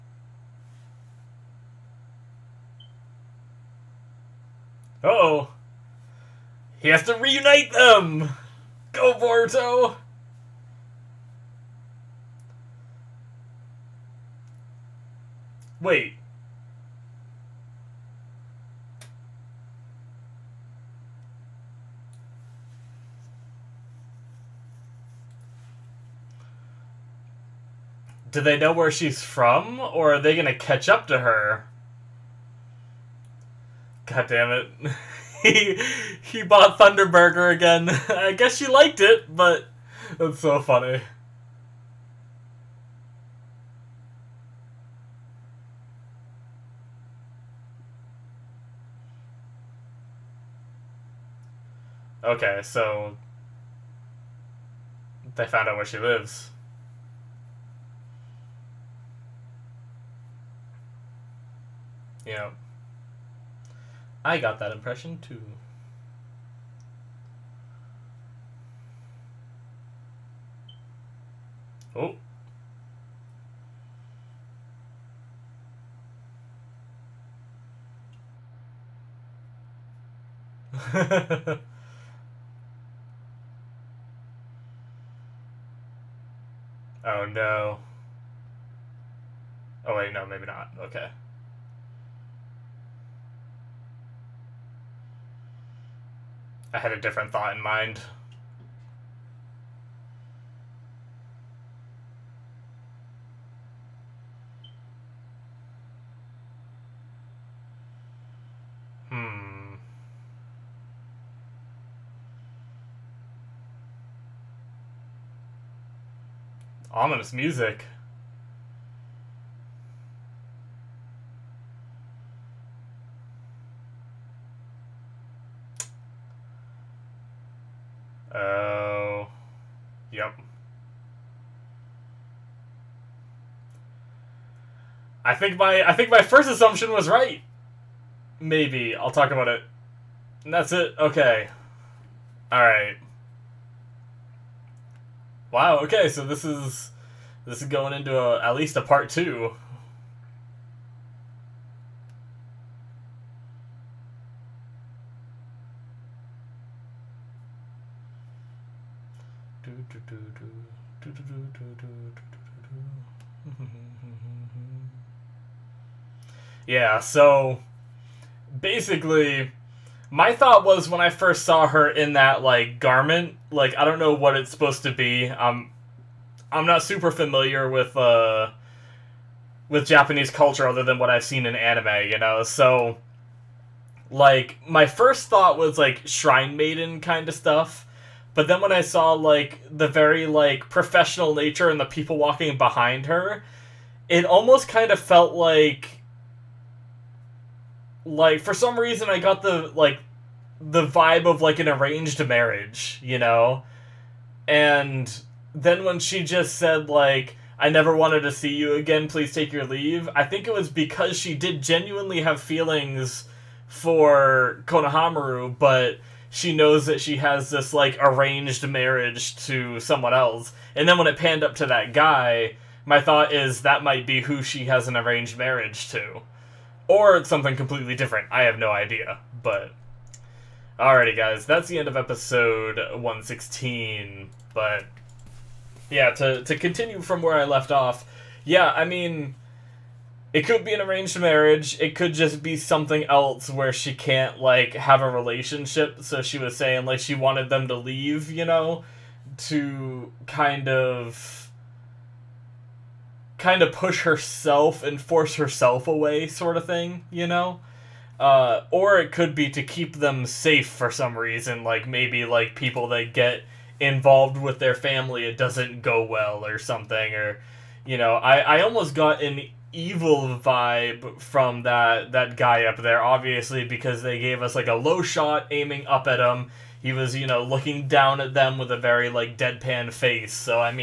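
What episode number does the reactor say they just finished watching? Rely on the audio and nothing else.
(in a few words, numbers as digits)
116.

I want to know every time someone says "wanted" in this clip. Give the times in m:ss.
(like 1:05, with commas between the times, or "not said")
3:27, 4:07.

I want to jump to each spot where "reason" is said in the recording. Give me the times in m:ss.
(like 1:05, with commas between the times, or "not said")
3:18, 4:21.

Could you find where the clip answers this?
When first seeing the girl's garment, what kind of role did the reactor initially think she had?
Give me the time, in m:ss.
3:06.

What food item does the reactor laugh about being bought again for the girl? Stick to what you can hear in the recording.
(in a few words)
Thunderburger.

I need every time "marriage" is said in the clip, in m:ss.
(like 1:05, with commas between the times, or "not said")
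3:22, 3:38, 3:45, 4:01.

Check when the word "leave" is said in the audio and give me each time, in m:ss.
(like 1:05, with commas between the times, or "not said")
3:29, 4:07.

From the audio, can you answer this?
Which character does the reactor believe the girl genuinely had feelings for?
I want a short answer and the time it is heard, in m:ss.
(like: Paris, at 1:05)
Konohamaru, at 3:34.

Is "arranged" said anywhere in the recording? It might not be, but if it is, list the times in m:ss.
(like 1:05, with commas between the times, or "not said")
3:21, 3:37, 3:44, 4:00.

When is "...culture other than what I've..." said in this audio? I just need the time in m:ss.
3:00.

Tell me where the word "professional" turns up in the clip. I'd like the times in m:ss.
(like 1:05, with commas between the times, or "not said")
3:10.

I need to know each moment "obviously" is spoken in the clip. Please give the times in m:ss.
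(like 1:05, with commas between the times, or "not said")
4:33.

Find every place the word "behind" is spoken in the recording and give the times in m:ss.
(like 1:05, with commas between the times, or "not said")
3:12.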